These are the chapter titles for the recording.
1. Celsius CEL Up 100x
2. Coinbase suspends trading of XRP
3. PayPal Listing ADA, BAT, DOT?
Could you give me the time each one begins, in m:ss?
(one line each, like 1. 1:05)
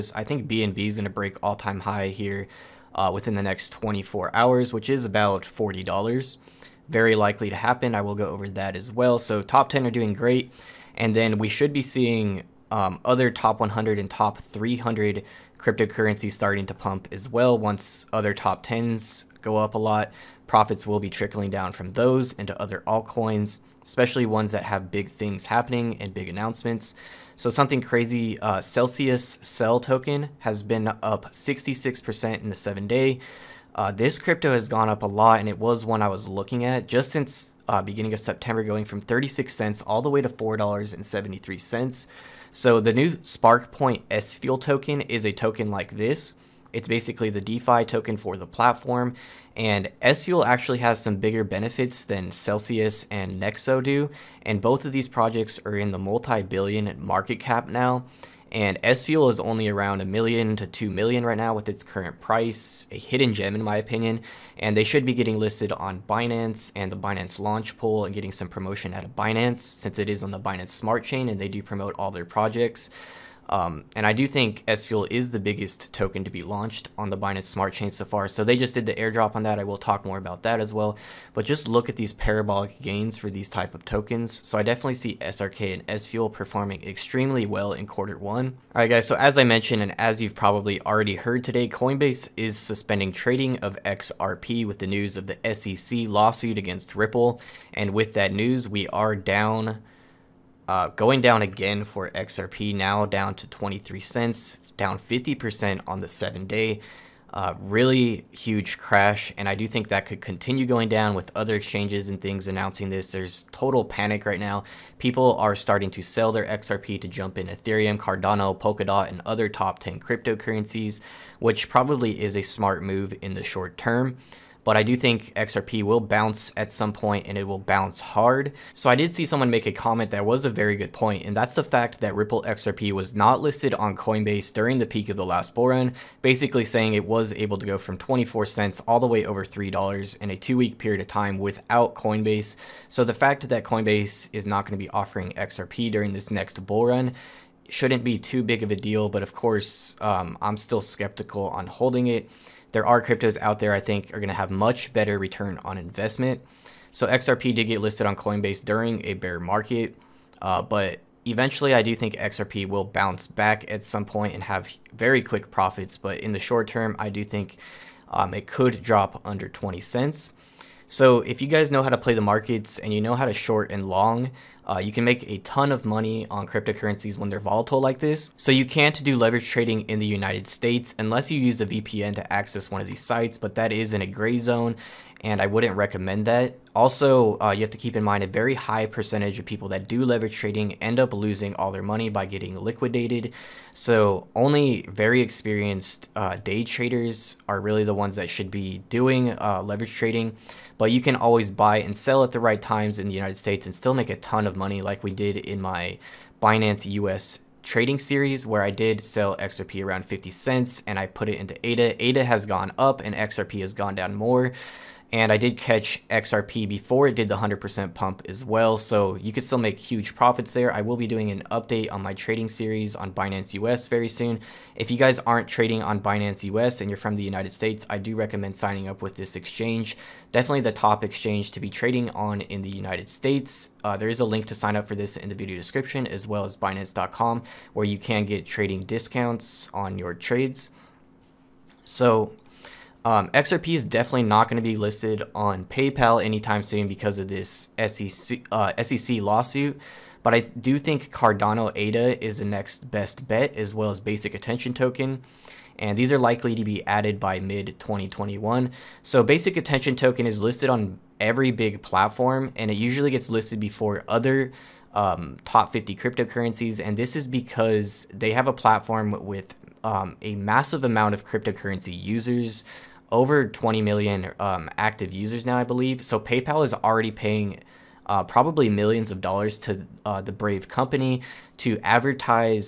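1. 0:24
2. 1:27
3. 4:02.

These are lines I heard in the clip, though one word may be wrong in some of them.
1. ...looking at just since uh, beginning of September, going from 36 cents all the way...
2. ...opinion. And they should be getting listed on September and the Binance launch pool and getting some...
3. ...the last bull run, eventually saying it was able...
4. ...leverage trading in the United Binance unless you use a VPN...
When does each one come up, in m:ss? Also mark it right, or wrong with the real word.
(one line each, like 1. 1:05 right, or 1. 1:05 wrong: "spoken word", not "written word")
1. 0:36 right
2. 1:03 wrong: "Binance", not "September"
3. 2:15 wrong: "basically", not "eventually"
4. 2:59 wrong: "States", not "Binance".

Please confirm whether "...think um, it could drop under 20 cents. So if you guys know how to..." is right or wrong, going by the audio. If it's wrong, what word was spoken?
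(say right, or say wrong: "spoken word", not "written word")
right.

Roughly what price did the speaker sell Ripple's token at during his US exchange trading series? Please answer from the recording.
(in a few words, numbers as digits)
50 cents.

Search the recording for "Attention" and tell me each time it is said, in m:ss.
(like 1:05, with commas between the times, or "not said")
4:14, 4:19.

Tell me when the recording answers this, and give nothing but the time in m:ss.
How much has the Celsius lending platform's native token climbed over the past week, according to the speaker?
0:31.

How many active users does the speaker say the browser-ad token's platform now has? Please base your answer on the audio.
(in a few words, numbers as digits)
over 20 million.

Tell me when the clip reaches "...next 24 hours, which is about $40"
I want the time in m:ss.
0:03.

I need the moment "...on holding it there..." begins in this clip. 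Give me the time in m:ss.
2:31.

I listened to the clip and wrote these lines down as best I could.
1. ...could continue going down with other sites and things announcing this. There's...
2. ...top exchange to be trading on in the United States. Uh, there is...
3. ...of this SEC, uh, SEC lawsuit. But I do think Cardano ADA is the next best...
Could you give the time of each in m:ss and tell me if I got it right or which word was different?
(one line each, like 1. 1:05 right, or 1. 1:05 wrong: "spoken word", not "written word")
1. 1:50 wrong: "exchanges", not "sites"
2. 3:50 right
3. 4:07 right.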